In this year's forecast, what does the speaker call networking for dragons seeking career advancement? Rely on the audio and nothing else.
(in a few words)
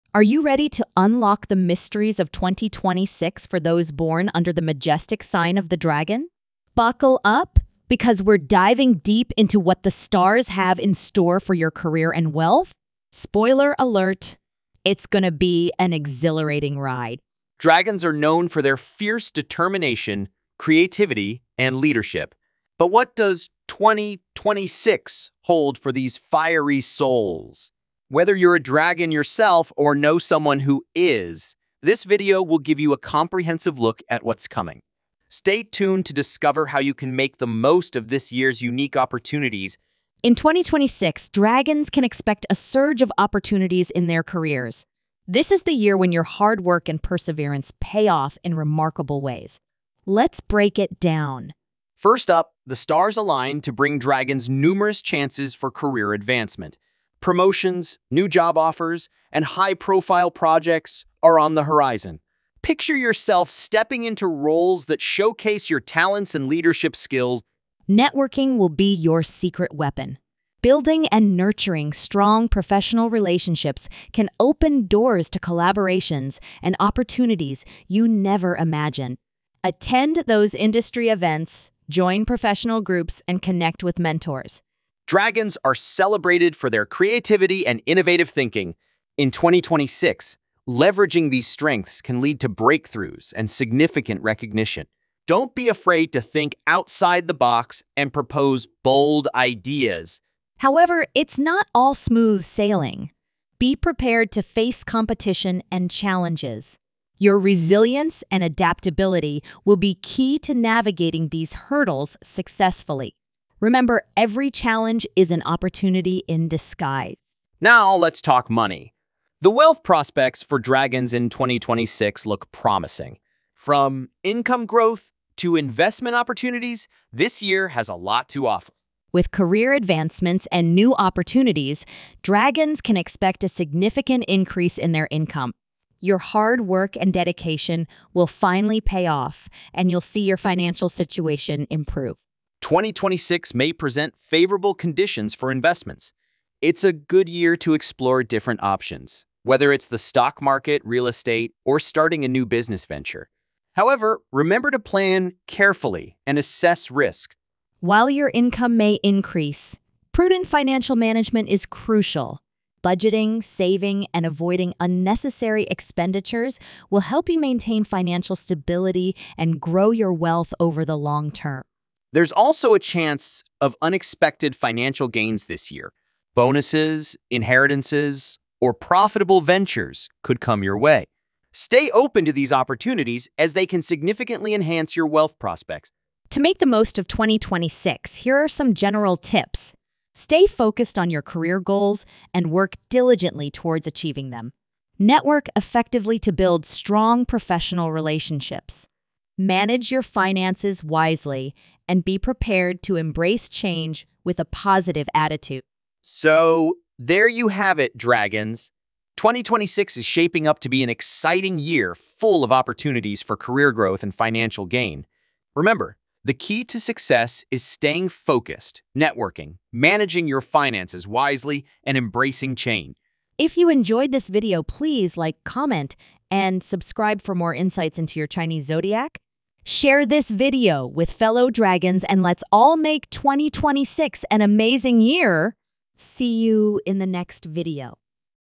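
secret weapon.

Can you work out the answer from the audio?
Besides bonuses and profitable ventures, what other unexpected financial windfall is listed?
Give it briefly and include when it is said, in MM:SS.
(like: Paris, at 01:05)
inheritances, at 02:57.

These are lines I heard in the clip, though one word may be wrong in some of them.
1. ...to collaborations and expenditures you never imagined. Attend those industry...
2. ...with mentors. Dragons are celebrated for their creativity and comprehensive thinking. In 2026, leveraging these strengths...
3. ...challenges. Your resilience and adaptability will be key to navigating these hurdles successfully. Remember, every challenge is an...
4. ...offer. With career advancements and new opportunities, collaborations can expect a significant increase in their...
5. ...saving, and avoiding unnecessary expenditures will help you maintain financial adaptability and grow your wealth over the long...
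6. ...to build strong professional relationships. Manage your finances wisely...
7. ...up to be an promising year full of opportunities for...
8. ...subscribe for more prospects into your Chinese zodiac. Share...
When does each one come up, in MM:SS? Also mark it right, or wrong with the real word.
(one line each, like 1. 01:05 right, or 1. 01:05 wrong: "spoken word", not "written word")
1. 01:15 wrong: "opportunities", not "expenditures"
2. 01:23 wrong: "innovative", not "comprehensive"
3. 01:45 right
4. 02:08 wrong: "dragons", not "collaborations"
5. 02:43 wrong: "stability", not "adaptability"
6. 03:16 right
7. 03:30 wrong: "exciting", not "promising"
8. 03:46 wrong: "insights", not "prospects".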